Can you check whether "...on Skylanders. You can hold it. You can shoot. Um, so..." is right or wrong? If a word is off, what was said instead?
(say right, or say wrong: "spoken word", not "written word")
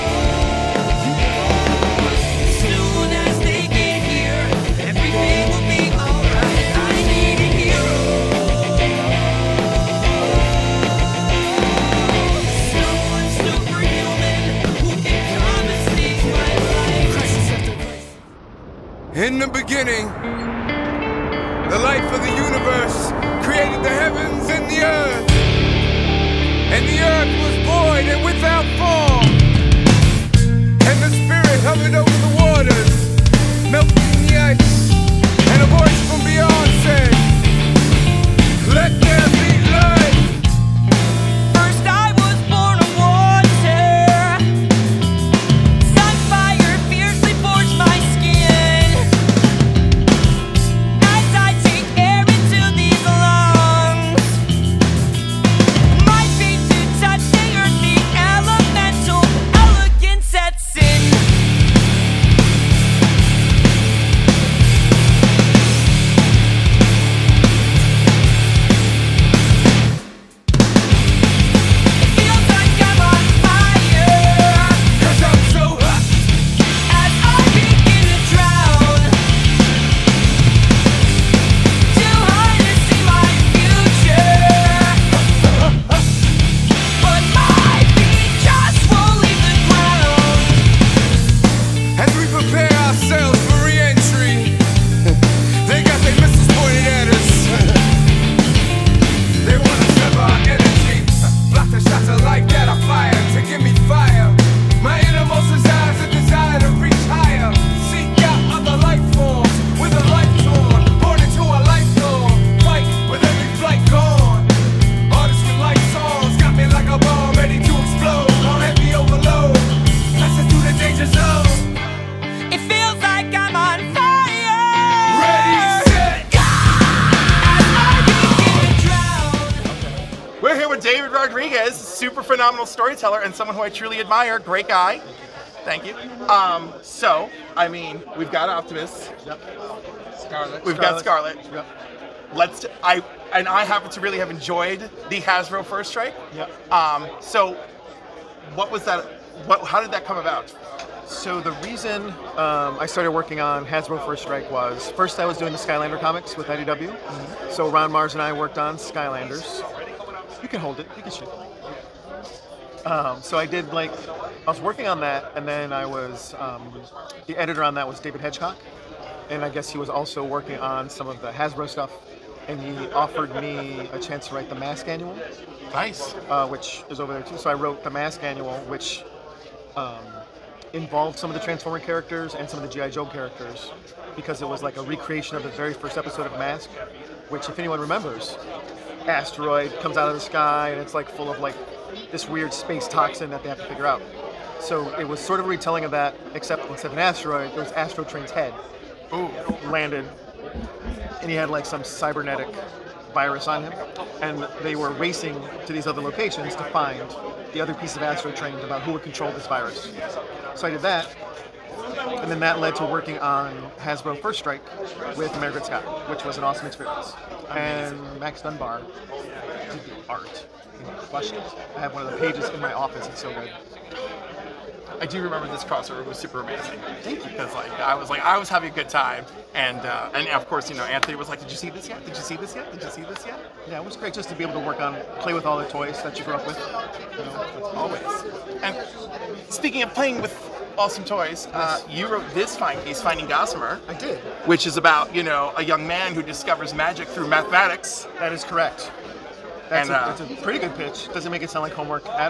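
right.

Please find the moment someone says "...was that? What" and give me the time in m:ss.
2:28.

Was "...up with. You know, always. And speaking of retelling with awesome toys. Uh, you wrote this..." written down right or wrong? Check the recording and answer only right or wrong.
wrong.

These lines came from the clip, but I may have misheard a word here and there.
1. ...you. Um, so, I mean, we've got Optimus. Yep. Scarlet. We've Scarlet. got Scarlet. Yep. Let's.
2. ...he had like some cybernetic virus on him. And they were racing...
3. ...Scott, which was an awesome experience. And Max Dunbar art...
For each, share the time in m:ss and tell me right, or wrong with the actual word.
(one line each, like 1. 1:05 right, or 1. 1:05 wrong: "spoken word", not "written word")
1. 2:15 right
2. 3:21 right
3. 3:35 right.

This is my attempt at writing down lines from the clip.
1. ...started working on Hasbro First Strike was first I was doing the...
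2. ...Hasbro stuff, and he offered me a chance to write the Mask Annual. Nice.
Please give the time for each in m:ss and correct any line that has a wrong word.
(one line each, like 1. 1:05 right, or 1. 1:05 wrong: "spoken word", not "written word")
1. 2:32 right
2. 2:51 right.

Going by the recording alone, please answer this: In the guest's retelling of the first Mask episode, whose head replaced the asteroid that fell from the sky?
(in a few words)
Astrotrain.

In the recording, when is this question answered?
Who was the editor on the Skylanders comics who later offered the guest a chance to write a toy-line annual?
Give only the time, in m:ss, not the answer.
2:47.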